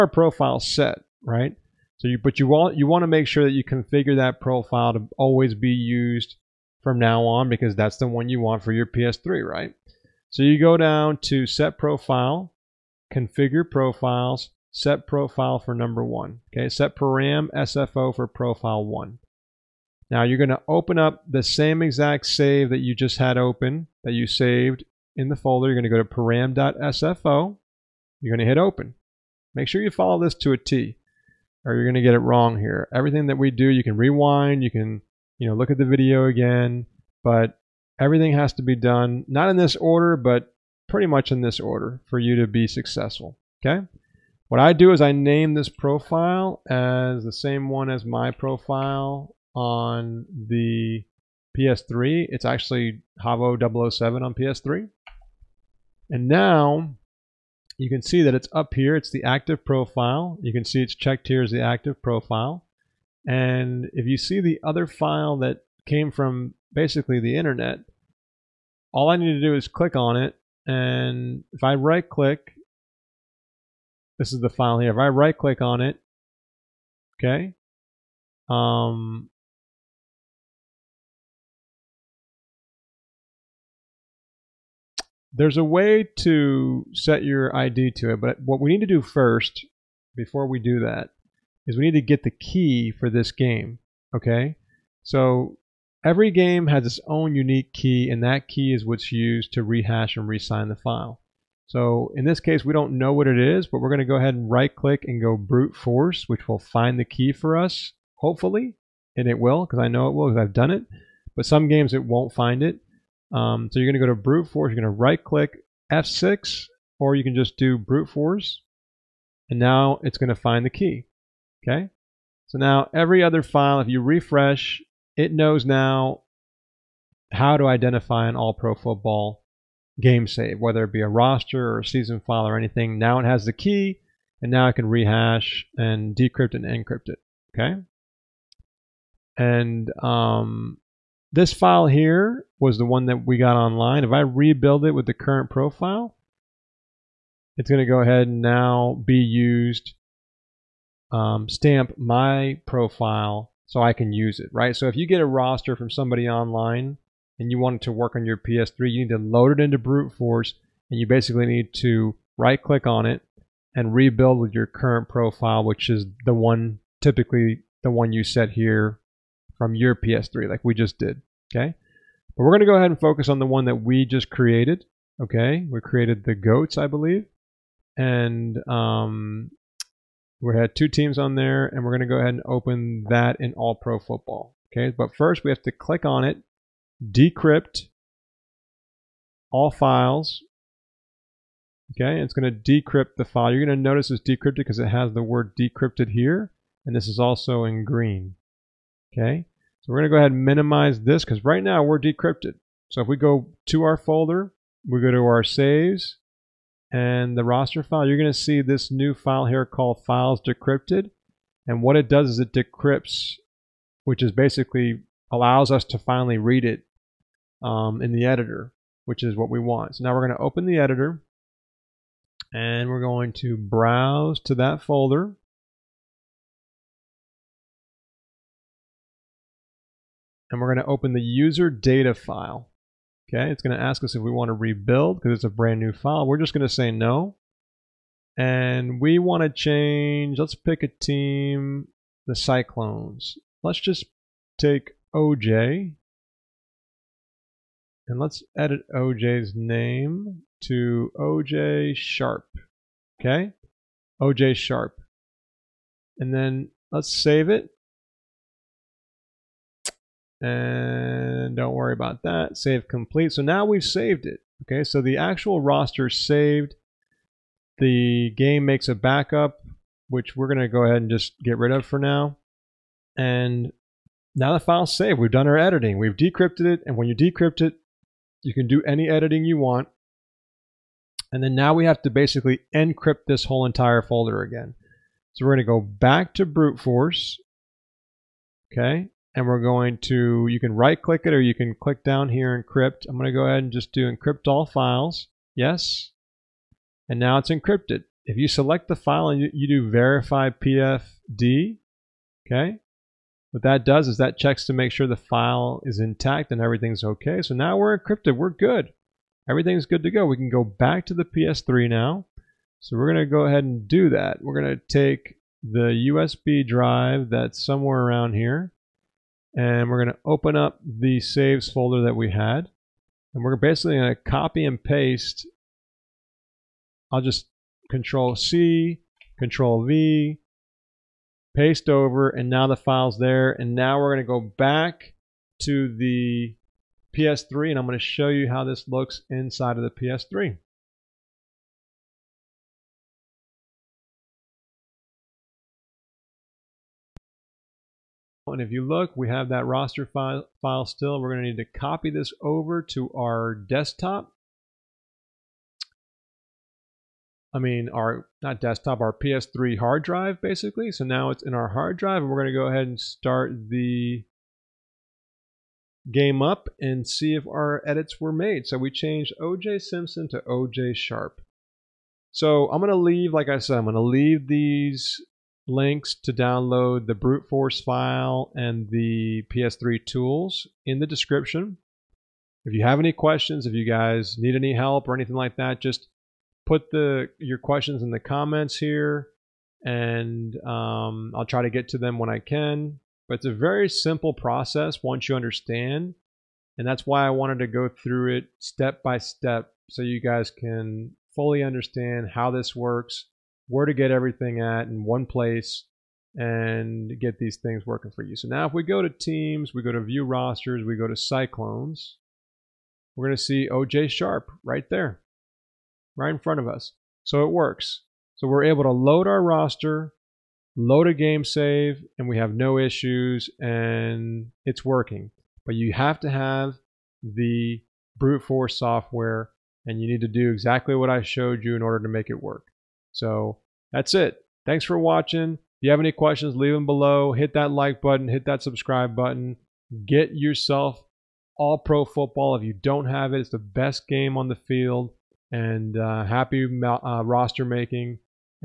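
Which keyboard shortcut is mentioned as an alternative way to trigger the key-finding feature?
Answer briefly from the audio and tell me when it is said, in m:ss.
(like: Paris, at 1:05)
F6, at 1:55.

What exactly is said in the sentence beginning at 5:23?
And we're basically going to copy and paste.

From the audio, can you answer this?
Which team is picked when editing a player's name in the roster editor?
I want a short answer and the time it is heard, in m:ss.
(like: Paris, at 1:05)
the Cyclones, at 4:02.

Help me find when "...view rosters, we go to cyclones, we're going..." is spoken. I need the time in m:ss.
6:50.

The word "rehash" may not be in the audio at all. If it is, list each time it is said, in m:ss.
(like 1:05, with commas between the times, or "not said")
1:39, 2:14.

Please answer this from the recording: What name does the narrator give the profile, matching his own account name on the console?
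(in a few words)
Javo 007.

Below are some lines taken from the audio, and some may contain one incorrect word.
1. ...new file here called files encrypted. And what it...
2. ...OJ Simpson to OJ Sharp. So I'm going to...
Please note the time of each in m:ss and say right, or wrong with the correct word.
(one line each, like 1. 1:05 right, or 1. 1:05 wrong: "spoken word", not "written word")
1. 3:28 wrong: "decrypted", not "encrypted"
2. 6:09 right.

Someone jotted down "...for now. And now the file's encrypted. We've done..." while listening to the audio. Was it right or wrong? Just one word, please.
wrong.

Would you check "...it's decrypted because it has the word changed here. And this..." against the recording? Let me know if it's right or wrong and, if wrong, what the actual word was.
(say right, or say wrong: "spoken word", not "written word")
wrong: "decrypted", not "changed".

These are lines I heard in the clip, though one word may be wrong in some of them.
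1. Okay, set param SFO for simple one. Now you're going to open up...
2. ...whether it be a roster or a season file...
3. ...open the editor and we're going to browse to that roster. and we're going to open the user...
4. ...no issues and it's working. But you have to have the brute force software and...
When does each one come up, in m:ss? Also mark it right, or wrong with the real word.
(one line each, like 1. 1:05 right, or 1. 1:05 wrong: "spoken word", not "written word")
1. 0:16 wrong: "profile", not "simple"
2. 2:10 right
3. 3:40 wrong: "folder", not "roster"
4. 7:02 right.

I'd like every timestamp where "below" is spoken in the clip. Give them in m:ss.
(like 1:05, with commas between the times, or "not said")
7:16.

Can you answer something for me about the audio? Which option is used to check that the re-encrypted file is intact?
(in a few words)
verify PFD.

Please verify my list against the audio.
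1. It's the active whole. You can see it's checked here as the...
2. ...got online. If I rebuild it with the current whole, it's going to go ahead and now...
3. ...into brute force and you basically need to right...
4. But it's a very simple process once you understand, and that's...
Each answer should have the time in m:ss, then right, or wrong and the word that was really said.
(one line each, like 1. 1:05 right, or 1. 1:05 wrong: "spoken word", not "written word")
1. 0:58 wrong: "profile", not "whole"
2. 2:23 wrong: "profile", not "whole"
3. 2:39 right
4. 6:33 right.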